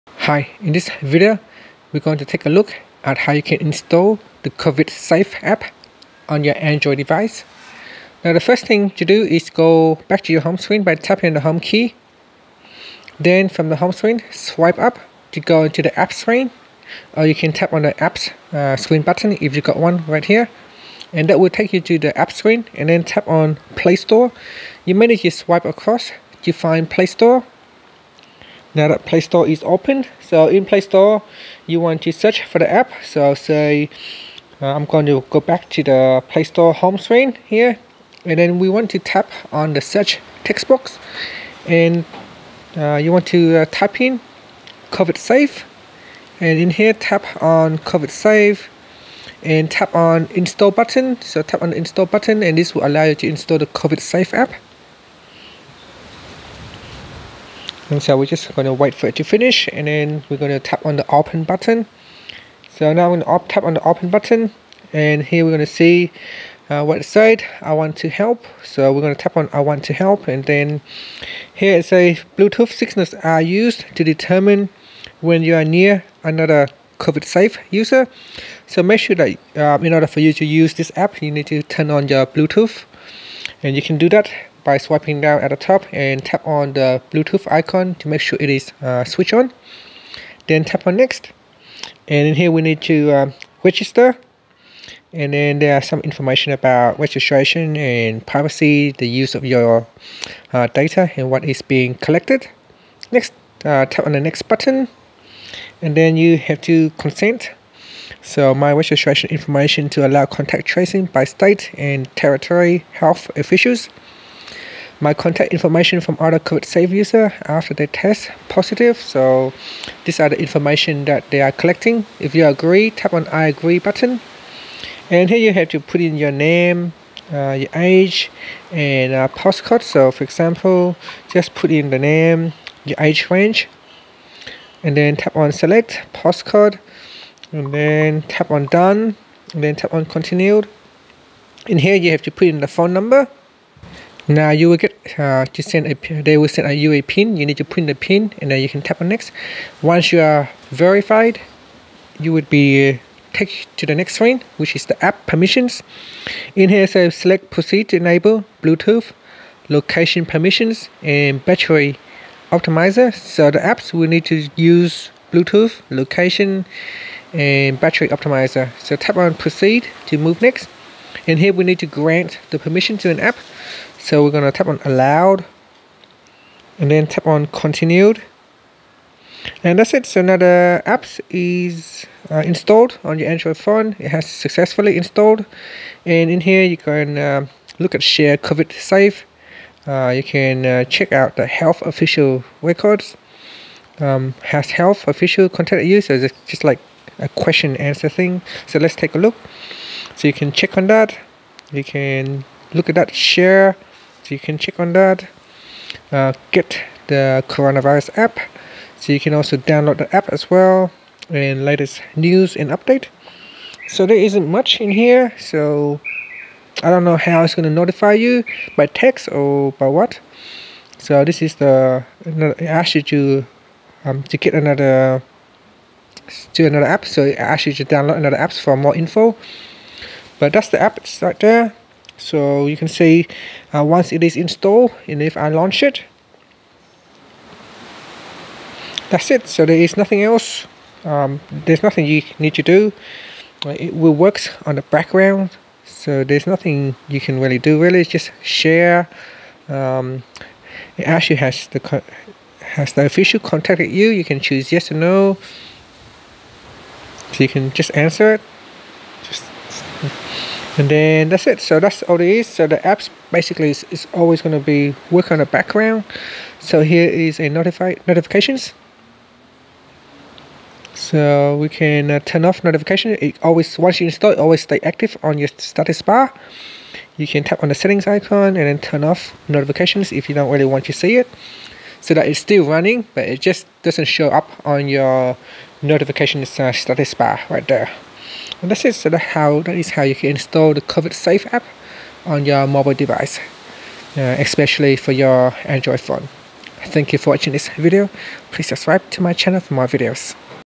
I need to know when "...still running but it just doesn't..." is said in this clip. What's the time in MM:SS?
04:42.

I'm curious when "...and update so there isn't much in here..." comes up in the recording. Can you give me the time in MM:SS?
03:32.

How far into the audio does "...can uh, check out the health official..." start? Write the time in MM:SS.
03:10.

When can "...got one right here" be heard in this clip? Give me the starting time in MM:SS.
00:19.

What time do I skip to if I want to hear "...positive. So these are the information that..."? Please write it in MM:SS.
01:58.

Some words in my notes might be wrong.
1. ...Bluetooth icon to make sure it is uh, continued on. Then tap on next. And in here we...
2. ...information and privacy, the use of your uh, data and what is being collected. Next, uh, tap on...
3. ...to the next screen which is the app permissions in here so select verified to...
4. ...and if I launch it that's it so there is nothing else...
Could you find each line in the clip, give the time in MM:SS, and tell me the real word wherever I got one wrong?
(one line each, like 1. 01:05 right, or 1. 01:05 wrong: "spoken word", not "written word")
1. 01:27 wrong: "switched", not "continued"
2. 01:36 wrong: "registration", not "information"
3. 02:33 wrong: "proceed", not "verified"
4. 03:55 right.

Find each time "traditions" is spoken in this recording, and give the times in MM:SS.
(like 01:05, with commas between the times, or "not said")
not said.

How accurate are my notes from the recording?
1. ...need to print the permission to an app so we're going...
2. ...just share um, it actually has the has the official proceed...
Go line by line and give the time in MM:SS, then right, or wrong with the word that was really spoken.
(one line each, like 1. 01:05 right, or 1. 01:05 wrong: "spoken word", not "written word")
1. 02:51 wrong: "grant", not "print"
2. 04:08 wrong: "contacted", not "proceed".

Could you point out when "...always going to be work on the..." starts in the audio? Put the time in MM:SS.
04:24.